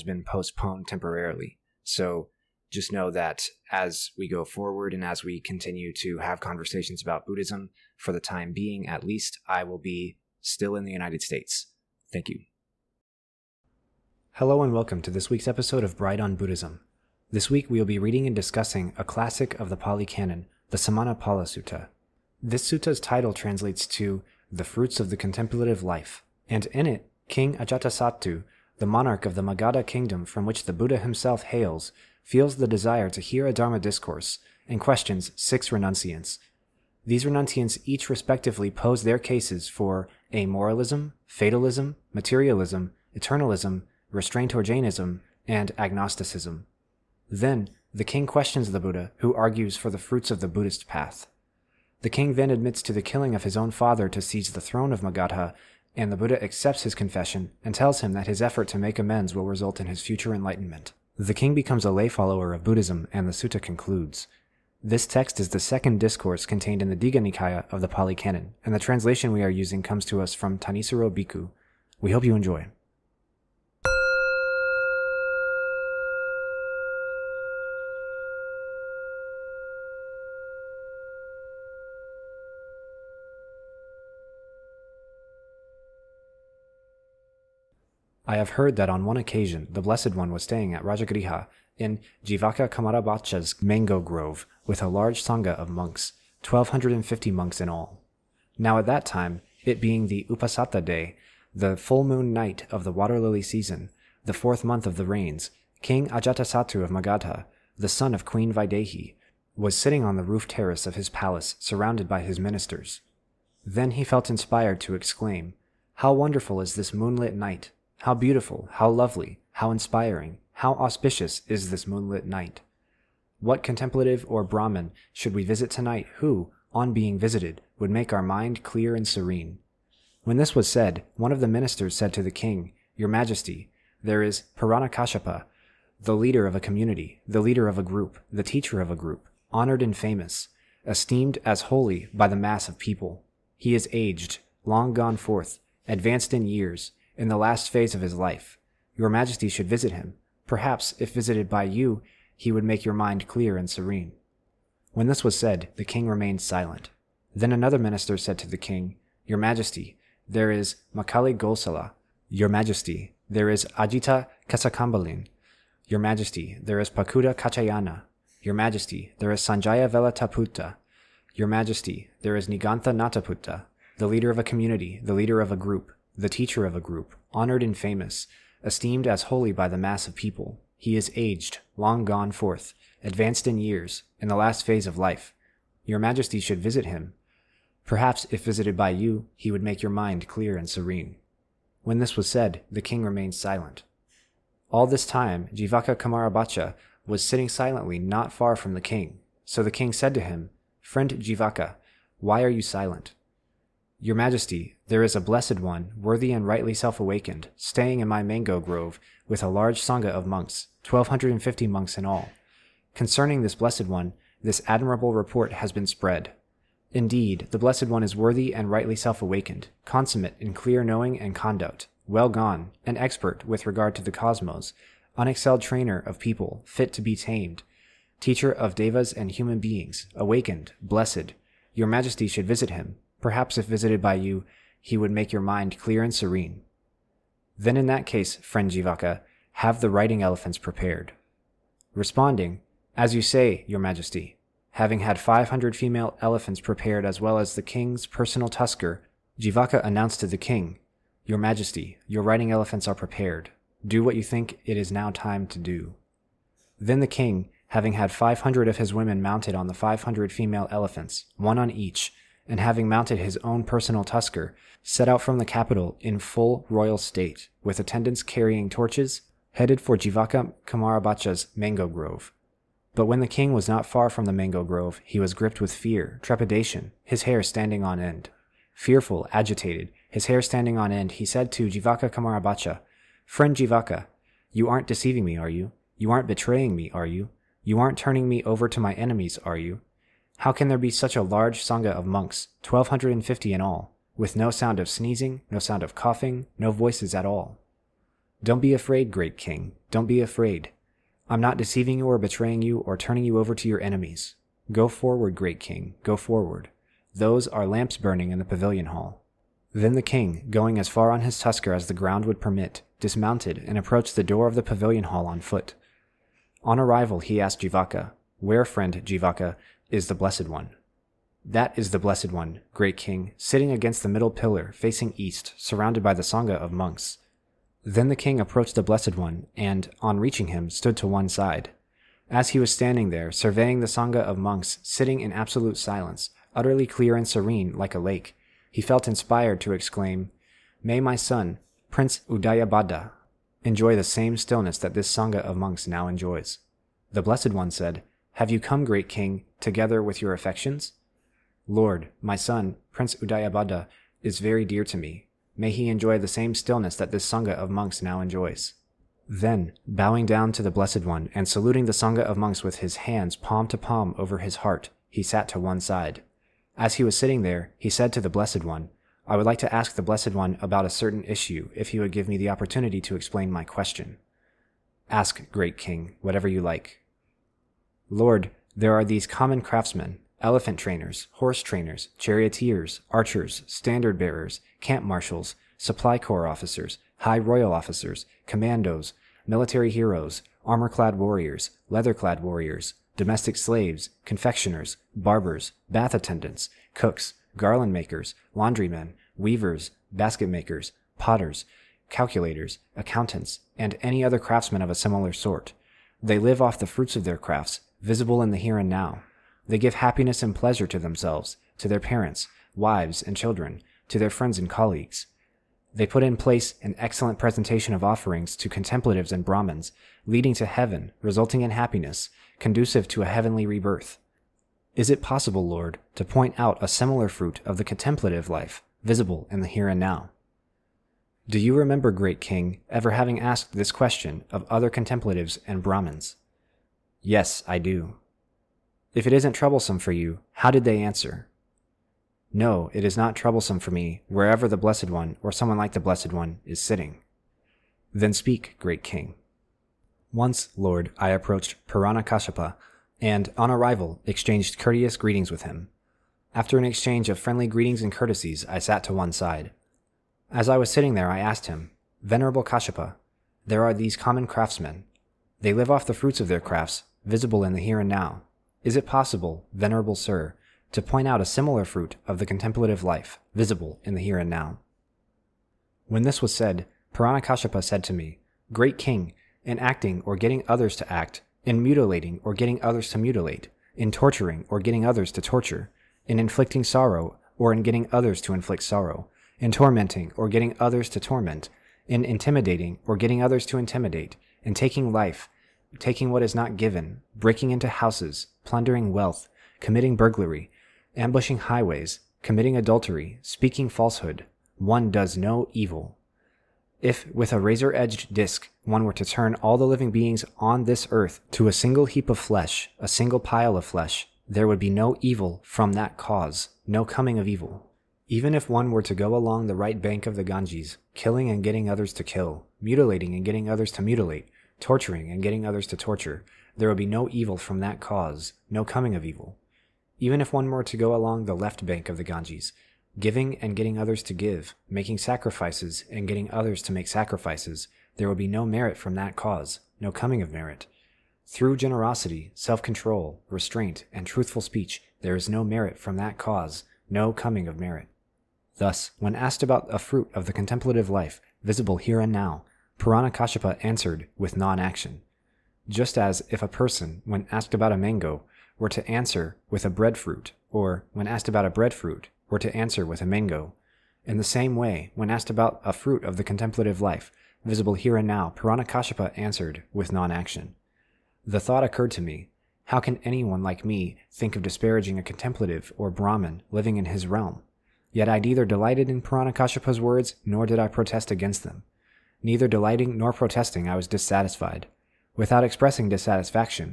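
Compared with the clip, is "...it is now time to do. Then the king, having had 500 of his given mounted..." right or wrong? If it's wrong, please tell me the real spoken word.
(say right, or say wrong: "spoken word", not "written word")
wrong: "women", not "given".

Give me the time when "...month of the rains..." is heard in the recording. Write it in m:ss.
1:44.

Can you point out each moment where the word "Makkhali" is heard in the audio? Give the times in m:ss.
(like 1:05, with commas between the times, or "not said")
2:40.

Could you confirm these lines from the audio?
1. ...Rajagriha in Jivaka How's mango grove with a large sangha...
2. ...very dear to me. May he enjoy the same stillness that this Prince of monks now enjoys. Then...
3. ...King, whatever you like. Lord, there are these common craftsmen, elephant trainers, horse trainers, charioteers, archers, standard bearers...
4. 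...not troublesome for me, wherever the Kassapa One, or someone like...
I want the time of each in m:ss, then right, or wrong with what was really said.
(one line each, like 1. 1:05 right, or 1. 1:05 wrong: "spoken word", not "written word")
1. 1:30 wrong: "Komarabhacca", not "How"
2. 5:54 wrong: "Sangha", not "Prince"
3. 6:15 right
4. 7:23 wrong: "Blessed", not "Kassapa".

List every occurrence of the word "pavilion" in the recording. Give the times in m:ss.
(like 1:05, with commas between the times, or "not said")
5:08, 5:14.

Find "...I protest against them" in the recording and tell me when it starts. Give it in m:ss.
9:40.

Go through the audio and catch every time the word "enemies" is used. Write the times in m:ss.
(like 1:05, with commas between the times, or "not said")
4:48, 5:03.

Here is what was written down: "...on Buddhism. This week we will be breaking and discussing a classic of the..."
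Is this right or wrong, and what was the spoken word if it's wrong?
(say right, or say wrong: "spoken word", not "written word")
wrong: "reading", not "breaking".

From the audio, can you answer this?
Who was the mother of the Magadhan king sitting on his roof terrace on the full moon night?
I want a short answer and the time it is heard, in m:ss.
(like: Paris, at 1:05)
Queen Vaidehi, at 1:48.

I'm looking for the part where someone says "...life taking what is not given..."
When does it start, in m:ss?
8:15.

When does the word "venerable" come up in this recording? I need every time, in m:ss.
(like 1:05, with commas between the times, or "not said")
7:42, 7:49.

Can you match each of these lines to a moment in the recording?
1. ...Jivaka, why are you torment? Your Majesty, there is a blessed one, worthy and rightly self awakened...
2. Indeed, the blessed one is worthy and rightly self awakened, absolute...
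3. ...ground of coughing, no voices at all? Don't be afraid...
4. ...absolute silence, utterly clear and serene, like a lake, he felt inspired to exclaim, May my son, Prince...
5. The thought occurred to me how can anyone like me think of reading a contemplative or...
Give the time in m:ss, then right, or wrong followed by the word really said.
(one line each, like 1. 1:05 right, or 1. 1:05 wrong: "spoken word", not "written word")
1. 3:21 wrong: "silent", not "torment"
2. 3:36 wrong: "consummate", not "absolute"
3. 4:55 wrong: "sound", not "ground"
4. 5:35 right
5. 9:31 wrong: "disparaging", not "reading".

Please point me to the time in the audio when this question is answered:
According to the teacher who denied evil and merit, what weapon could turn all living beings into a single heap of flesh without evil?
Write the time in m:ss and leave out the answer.
8:27.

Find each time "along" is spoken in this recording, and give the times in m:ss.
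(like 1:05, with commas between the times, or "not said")
8:39, 8:51.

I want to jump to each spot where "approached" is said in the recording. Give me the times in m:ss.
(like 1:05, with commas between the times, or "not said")
5:13, 5:28, 7:31.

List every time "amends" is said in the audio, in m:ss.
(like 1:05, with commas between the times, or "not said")
0:58.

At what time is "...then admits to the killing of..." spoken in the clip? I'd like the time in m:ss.
0:52.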